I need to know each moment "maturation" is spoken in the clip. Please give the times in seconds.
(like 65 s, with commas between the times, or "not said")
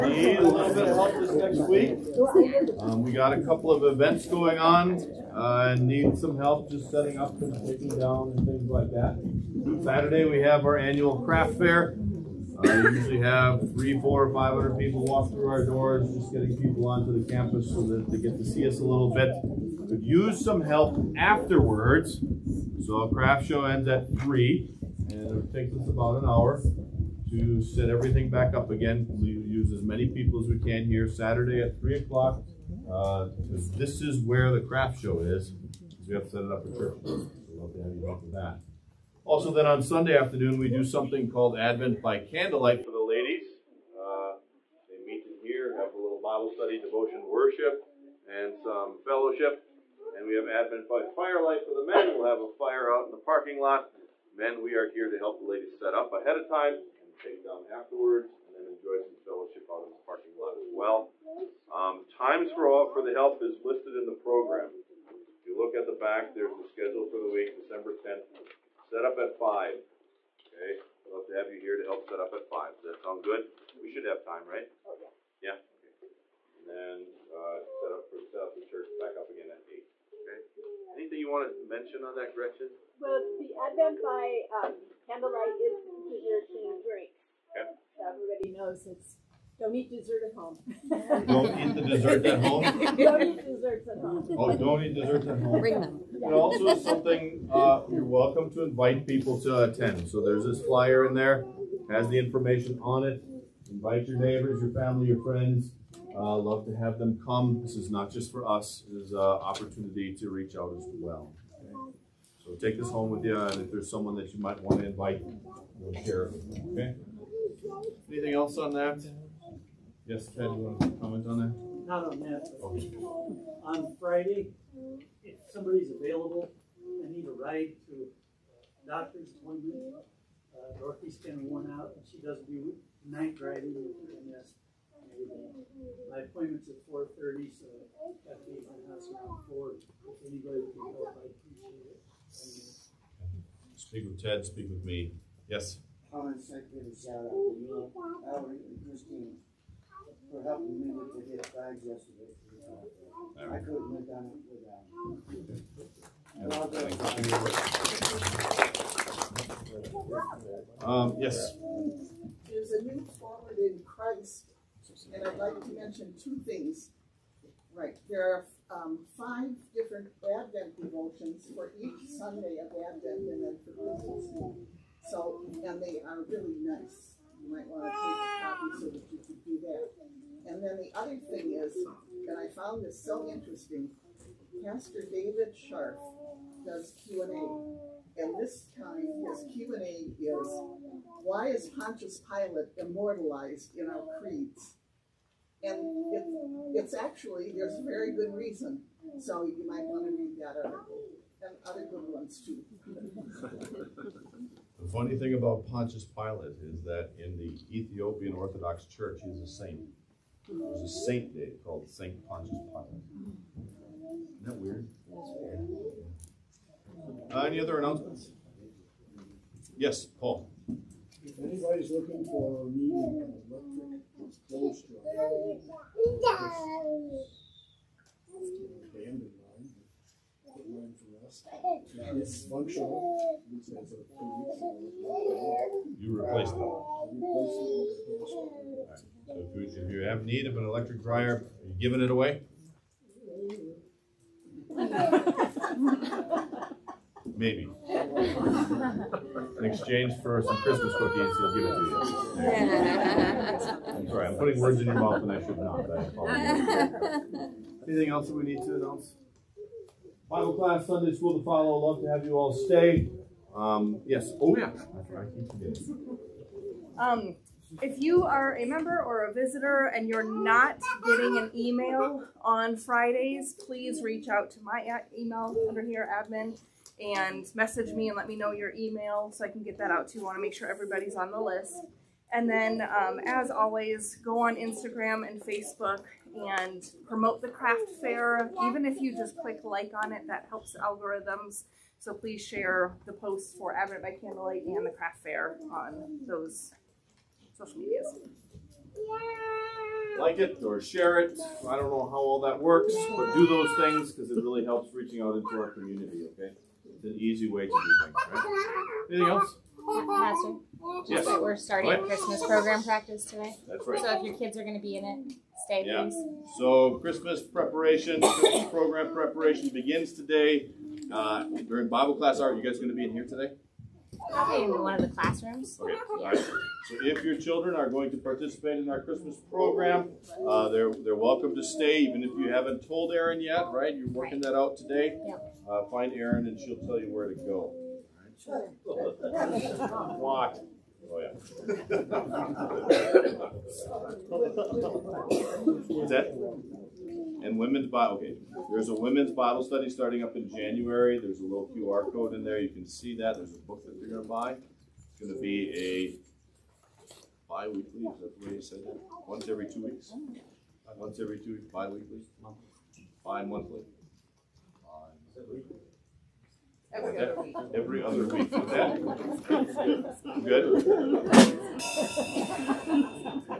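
not said.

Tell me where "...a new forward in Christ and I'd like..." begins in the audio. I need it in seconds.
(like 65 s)
162 s.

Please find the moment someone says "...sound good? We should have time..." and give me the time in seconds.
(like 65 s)
73 s.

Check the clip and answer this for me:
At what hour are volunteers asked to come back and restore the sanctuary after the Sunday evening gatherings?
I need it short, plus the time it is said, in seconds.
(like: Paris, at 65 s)
8, at 79 s.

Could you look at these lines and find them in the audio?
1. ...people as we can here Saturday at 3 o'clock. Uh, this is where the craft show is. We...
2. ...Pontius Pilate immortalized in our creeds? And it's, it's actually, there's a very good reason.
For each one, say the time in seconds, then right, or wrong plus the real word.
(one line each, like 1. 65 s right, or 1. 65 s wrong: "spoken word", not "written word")
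1. 30 s right
2. 191 s right.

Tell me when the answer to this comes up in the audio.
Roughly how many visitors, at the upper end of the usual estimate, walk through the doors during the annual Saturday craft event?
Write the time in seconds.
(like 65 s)
14 s.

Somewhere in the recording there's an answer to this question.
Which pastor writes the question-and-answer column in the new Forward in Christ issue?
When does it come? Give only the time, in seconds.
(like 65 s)
185 s.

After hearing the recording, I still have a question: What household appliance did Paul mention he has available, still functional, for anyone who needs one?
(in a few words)
electric dryer.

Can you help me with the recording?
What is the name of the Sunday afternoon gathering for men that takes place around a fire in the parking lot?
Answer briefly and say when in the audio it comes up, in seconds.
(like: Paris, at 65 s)
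Advent by Firelight, at 50 s.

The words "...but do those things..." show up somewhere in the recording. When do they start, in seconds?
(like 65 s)
303 s.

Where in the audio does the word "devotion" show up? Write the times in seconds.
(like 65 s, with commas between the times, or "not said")
46 s, 170 s.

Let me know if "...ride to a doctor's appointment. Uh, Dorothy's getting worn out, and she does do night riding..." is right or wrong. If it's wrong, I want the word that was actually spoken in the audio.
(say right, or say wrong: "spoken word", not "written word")
right.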